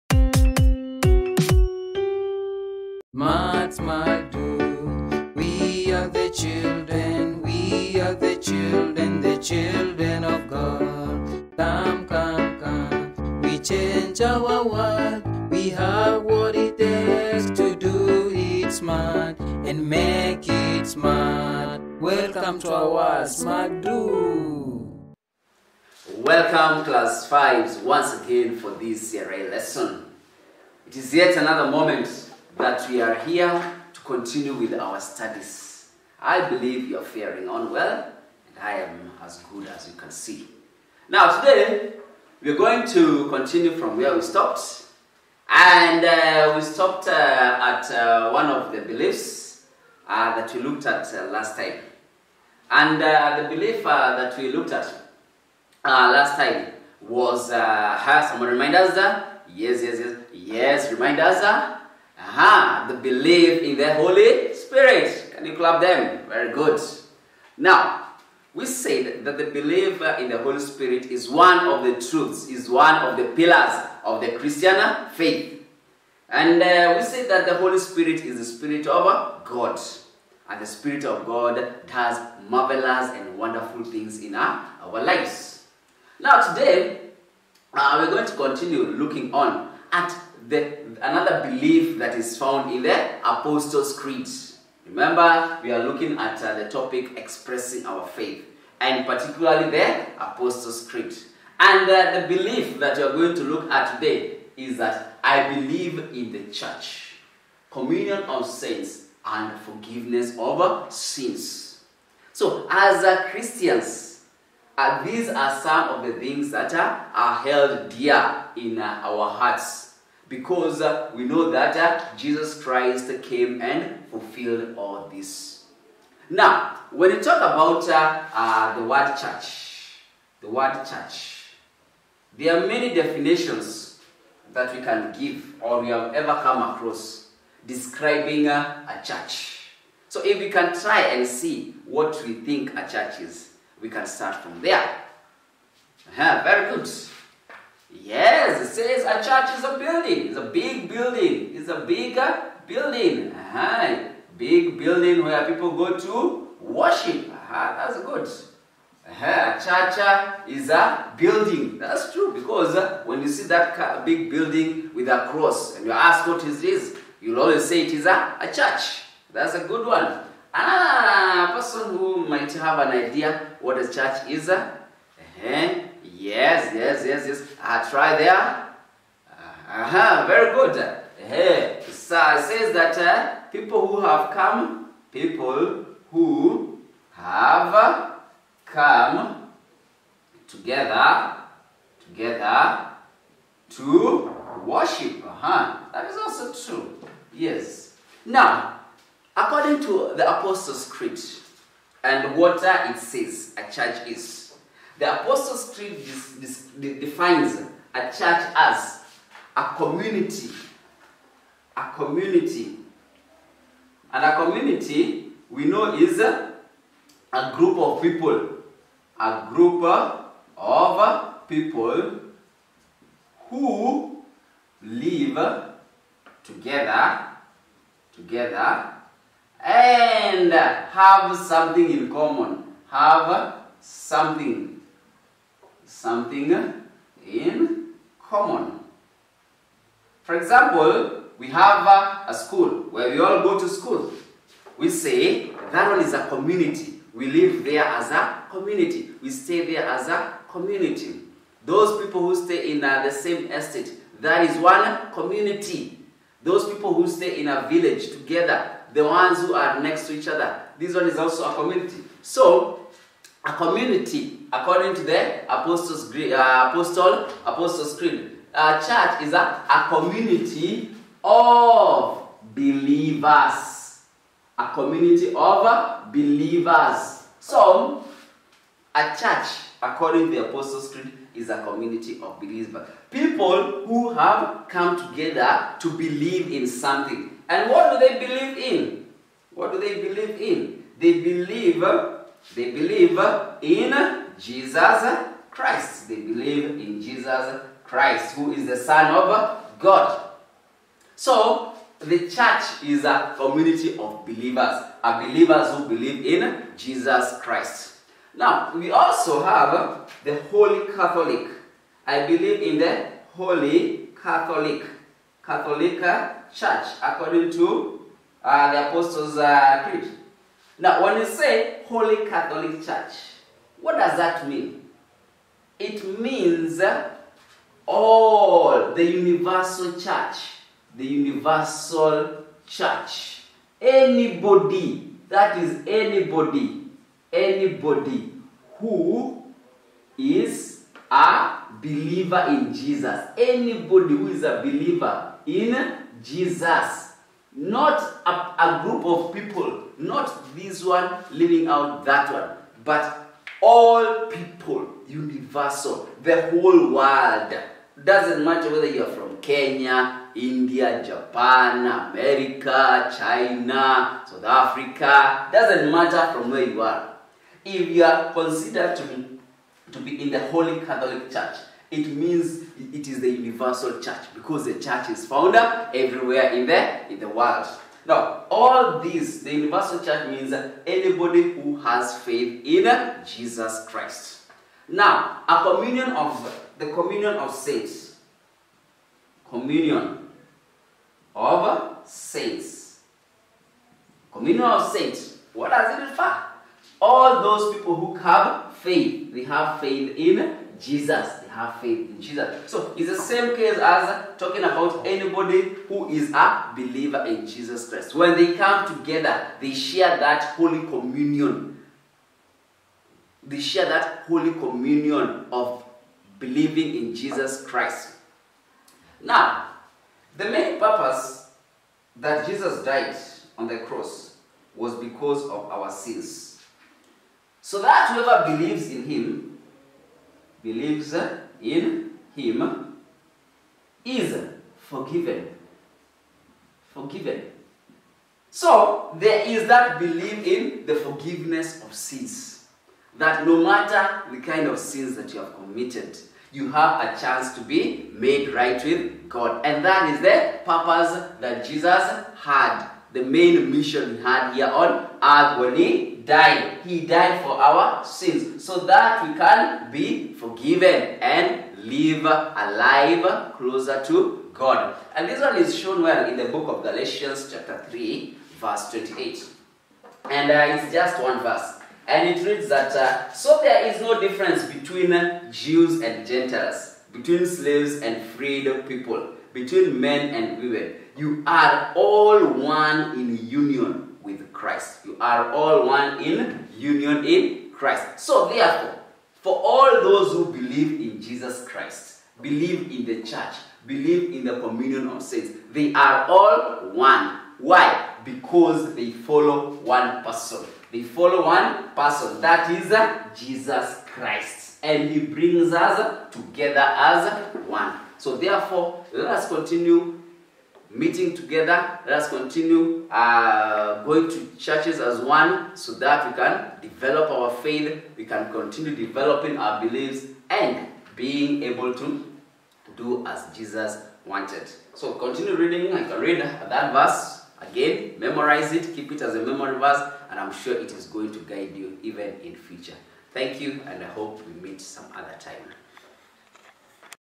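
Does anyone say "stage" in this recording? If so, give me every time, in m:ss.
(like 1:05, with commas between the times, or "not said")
not said.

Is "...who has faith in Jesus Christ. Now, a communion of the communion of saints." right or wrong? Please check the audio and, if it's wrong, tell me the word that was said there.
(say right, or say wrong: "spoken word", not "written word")
right.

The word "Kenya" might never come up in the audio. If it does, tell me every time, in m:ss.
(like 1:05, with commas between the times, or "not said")
5:59.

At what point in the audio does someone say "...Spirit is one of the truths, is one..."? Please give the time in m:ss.
1:10.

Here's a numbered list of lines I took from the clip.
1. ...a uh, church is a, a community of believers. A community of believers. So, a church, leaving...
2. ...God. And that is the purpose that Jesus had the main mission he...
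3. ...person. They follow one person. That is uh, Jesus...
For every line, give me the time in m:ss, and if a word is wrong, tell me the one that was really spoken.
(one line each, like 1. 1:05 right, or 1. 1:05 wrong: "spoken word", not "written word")
1. 4:28 wrong: "according", not "leaving"
2. 7:29 right
3. 8:20 right.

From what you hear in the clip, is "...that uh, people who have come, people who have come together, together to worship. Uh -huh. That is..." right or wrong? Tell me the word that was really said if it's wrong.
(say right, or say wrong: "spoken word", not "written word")
right.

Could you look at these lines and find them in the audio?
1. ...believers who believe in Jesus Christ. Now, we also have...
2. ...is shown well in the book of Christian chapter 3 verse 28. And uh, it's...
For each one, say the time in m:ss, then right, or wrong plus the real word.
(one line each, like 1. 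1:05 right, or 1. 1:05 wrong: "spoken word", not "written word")
1. 5:05 right
2. 7:45 wrong: "Galatians", not "Christian".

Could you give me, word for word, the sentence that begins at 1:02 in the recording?
Aha, the belief in the Holy Spirit.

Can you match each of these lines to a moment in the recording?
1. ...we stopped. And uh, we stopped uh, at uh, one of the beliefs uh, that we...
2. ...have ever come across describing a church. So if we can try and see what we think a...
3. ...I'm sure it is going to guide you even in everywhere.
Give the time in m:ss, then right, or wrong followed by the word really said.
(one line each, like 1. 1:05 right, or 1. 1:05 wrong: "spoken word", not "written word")
1. 0:44 right
2. 2:15 right
3. 8:50 wrong: "future", not "everywhere".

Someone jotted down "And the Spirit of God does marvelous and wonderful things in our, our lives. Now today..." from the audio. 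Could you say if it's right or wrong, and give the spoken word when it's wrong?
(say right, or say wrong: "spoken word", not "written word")
right.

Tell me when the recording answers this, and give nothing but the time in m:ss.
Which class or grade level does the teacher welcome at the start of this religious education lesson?
0:26.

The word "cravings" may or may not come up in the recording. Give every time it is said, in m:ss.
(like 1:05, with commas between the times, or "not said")
not said.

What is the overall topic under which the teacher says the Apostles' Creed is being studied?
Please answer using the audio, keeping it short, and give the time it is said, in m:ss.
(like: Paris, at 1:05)
Expressing our faith, at 1:37.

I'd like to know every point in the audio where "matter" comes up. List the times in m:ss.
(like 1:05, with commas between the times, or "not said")
5:58, 6:05, 7:23.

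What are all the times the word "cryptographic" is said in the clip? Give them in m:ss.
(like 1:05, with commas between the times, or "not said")
not said.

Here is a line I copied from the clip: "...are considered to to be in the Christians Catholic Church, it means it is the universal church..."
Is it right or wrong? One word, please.
wrong.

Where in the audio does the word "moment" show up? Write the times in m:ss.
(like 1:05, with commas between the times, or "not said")
0:31.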